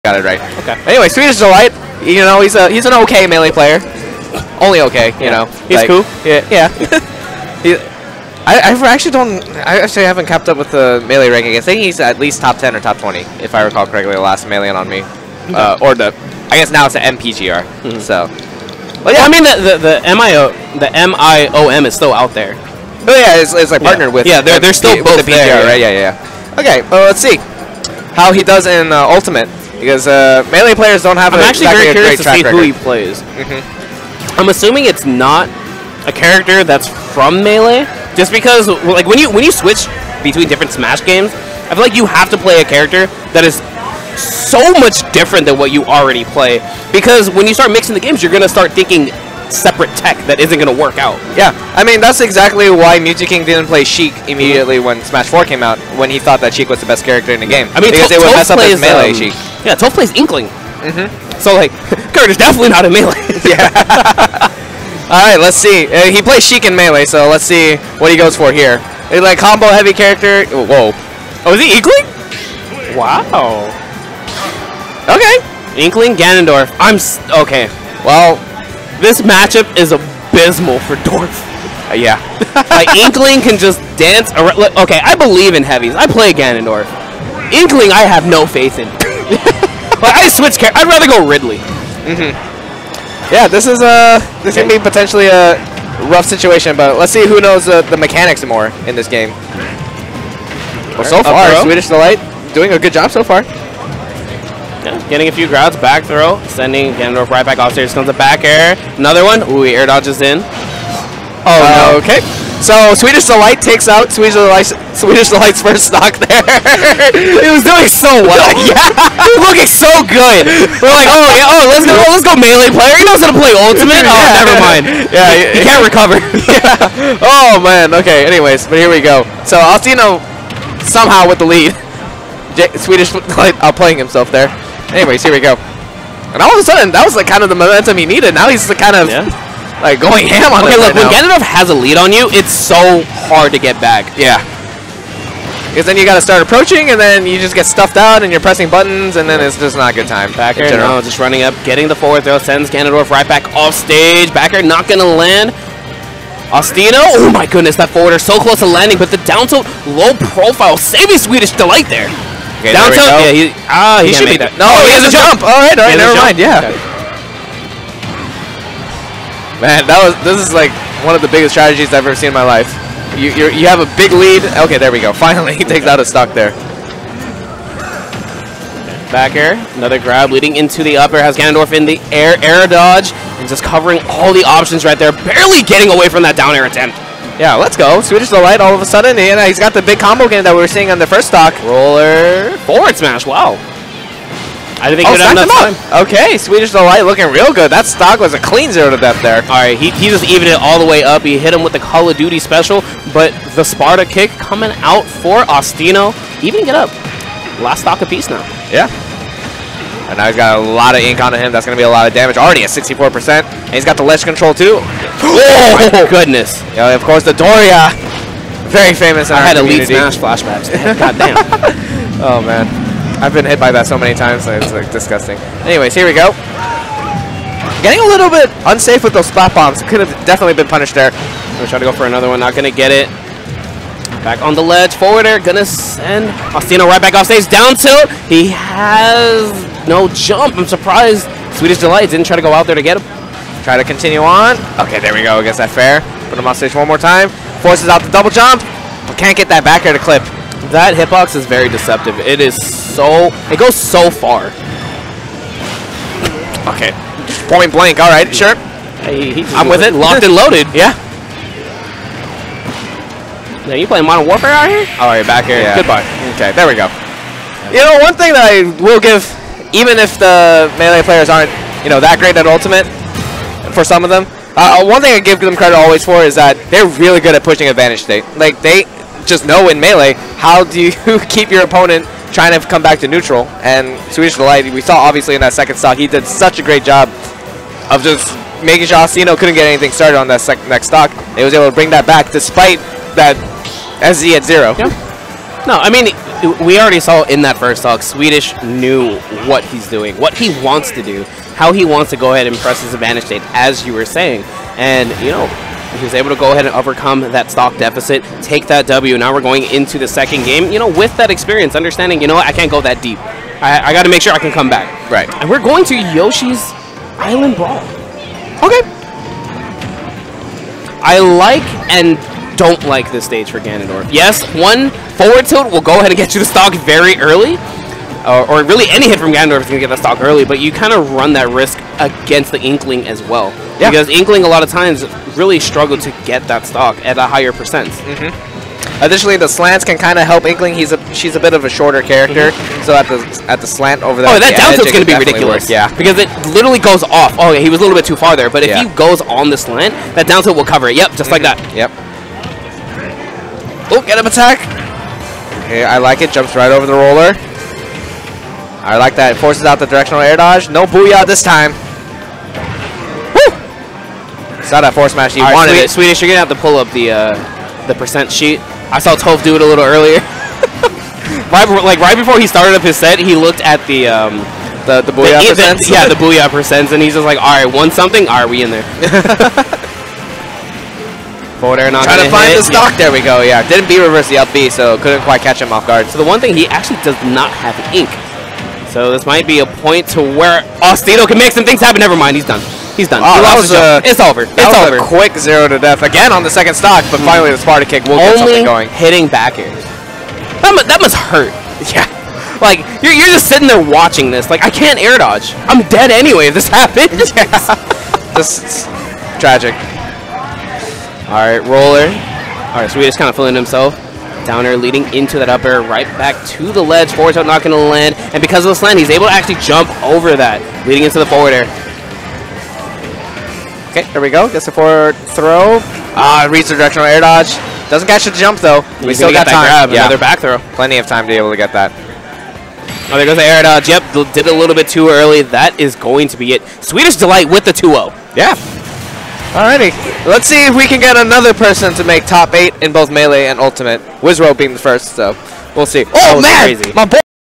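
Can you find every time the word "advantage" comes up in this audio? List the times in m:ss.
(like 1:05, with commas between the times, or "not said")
4:37, 5:02.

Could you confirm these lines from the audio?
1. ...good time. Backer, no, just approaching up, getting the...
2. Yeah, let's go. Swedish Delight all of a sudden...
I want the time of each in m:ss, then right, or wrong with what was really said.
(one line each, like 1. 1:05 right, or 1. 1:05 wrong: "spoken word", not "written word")
1. 2:29 wrong: "running", not "approaching"
2. 3:07 right.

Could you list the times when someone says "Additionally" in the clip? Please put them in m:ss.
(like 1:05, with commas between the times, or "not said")
5:39.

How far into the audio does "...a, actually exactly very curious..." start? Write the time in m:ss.
0:31.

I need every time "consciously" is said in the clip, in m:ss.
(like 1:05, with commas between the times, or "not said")
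not said.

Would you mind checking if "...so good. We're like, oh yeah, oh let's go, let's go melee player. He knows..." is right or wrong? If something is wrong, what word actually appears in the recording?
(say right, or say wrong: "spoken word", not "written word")
right.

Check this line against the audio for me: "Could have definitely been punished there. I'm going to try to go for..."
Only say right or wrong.
right.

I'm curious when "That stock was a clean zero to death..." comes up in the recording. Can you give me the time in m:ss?
3:17.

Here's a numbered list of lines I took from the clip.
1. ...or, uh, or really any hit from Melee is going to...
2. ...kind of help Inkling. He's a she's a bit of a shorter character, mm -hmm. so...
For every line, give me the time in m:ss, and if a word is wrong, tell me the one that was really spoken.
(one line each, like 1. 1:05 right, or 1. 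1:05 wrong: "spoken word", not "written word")
1. 5:28 wrong: "Ganondorf", not "Melee"
2. 5:39 right.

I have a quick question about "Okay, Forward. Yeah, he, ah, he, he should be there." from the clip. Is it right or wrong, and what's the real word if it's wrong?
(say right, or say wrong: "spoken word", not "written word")
wrong: "Downtown", not "Forward".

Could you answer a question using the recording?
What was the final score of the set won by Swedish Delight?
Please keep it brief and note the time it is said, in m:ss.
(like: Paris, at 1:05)
2-0, at 7:17.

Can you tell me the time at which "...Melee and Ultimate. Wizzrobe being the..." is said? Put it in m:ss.
7:23.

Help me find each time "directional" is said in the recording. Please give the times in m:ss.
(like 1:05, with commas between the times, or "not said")
5:59, 7:06.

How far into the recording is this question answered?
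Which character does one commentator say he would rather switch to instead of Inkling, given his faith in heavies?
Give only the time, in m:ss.
1:31.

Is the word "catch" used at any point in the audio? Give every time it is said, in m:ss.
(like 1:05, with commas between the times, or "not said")
6:25, 7:08.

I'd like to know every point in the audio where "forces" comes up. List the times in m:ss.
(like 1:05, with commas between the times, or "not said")
4:07, 5:59, 6:04.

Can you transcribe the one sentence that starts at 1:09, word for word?
He's uh, like combo heavy character.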